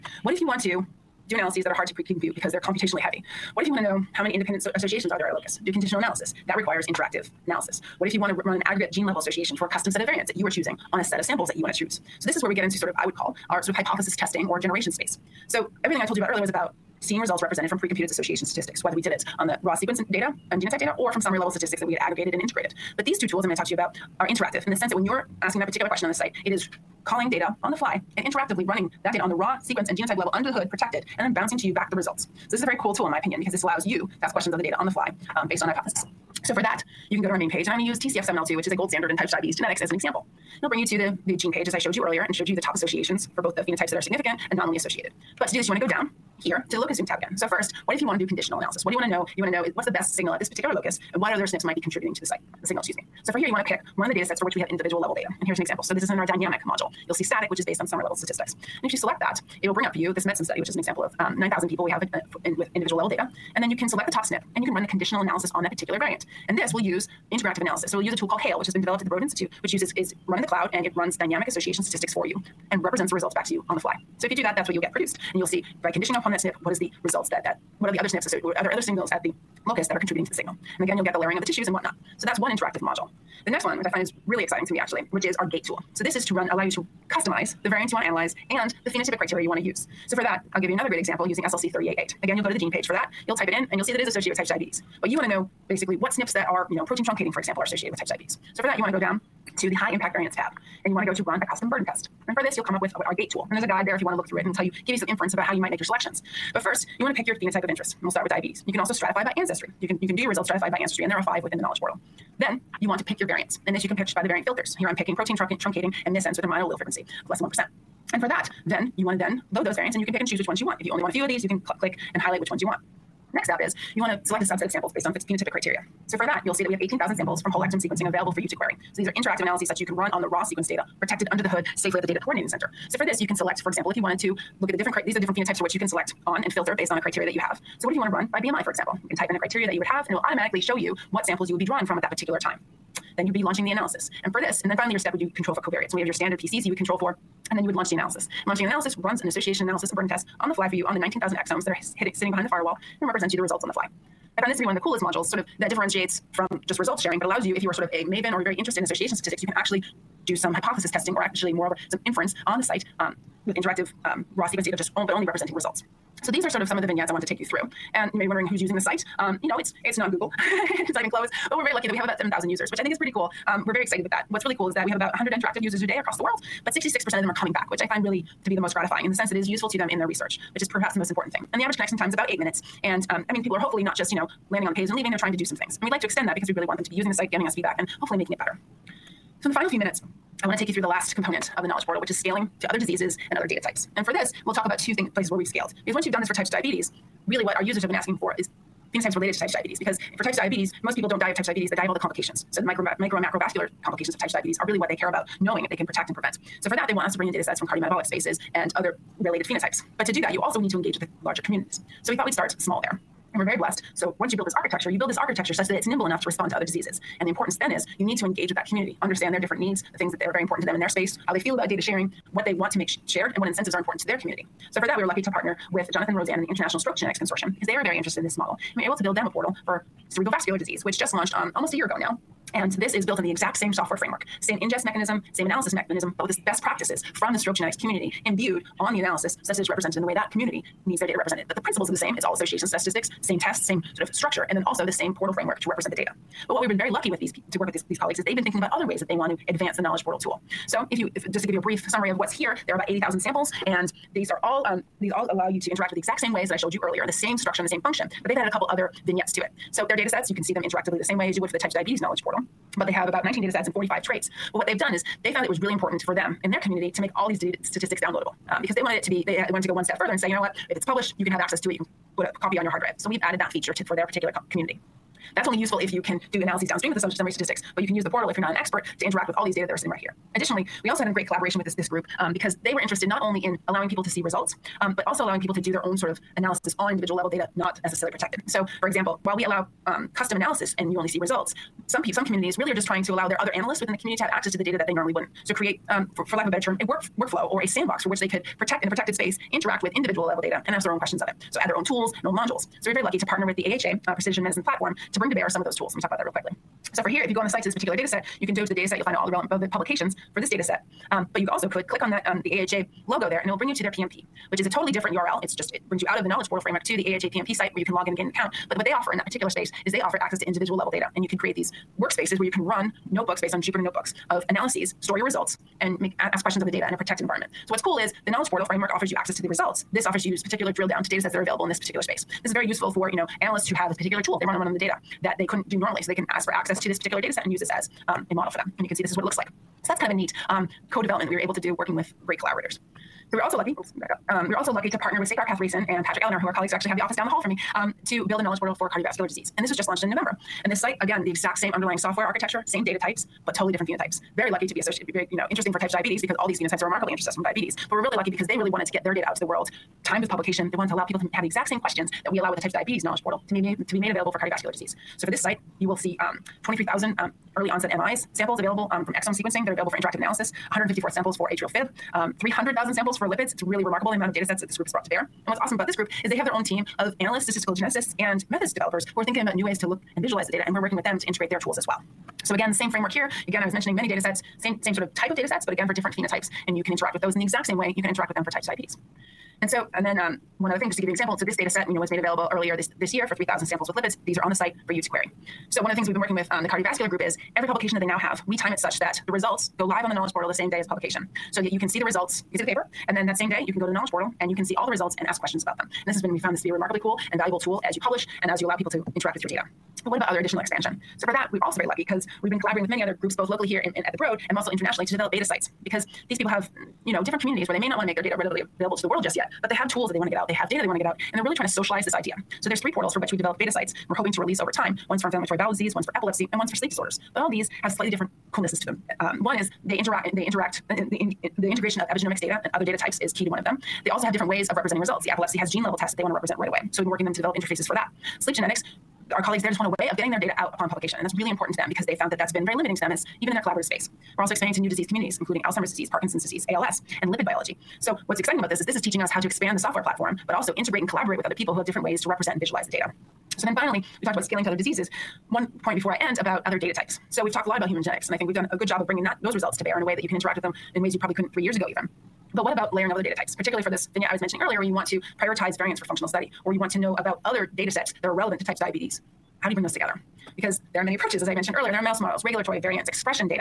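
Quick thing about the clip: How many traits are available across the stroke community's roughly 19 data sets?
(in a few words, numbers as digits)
45.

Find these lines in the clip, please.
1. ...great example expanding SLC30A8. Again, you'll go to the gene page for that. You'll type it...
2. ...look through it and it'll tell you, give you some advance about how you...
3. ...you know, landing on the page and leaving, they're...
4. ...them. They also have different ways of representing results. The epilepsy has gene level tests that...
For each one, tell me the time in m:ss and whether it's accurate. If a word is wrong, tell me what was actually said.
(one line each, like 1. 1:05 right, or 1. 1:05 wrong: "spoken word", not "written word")
1. 1:30 wrong: "using", not "expanding"
2. 1:44 wrong: "inference", not "advance"
3. 3:04 right
4. 7:13 right.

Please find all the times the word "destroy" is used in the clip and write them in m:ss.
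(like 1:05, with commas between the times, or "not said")
not said.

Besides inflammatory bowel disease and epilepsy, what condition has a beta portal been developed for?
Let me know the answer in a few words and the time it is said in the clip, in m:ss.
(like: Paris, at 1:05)
sleep disorders, at 7:06.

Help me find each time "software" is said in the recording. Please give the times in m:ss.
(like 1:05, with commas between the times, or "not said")
3:53, 5:51, 7:29.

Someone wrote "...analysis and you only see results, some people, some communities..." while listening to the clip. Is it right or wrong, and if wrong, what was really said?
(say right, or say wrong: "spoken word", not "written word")
right.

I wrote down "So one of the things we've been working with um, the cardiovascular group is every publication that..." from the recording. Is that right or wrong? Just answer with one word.
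right.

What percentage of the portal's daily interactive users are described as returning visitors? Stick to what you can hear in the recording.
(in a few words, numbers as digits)
66%.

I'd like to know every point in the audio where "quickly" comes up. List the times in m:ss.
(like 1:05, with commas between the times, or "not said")
5:06.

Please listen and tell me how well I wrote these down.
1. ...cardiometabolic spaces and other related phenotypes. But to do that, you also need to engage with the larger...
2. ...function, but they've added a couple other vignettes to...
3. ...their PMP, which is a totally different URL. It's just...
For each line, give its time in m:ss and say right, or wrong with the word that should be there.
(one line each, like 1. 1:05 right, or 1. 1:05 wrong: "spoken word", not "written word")
1. 3:27 right
2. 4:17 right
3. 5:13 right.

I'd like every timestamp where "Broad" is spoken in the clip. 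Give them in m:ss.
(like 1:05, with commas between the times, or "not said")
1:09, 6:54.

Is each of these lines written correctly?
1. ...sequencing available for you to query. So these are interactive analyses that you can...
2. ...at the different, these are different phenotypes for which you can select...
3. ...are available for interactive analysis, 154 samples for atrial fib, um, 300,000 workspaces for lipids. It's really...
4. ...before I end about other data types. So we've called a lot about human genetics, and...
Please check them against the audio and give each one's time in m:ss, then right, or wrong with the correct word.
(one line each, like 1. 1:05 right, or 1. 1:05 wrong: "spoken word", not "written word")
1. 2:07 right
2. 2:14 right
3. 6:09 wrong: "samples", not "workspaces"
4. 7:35 wrong: "talked", not "called".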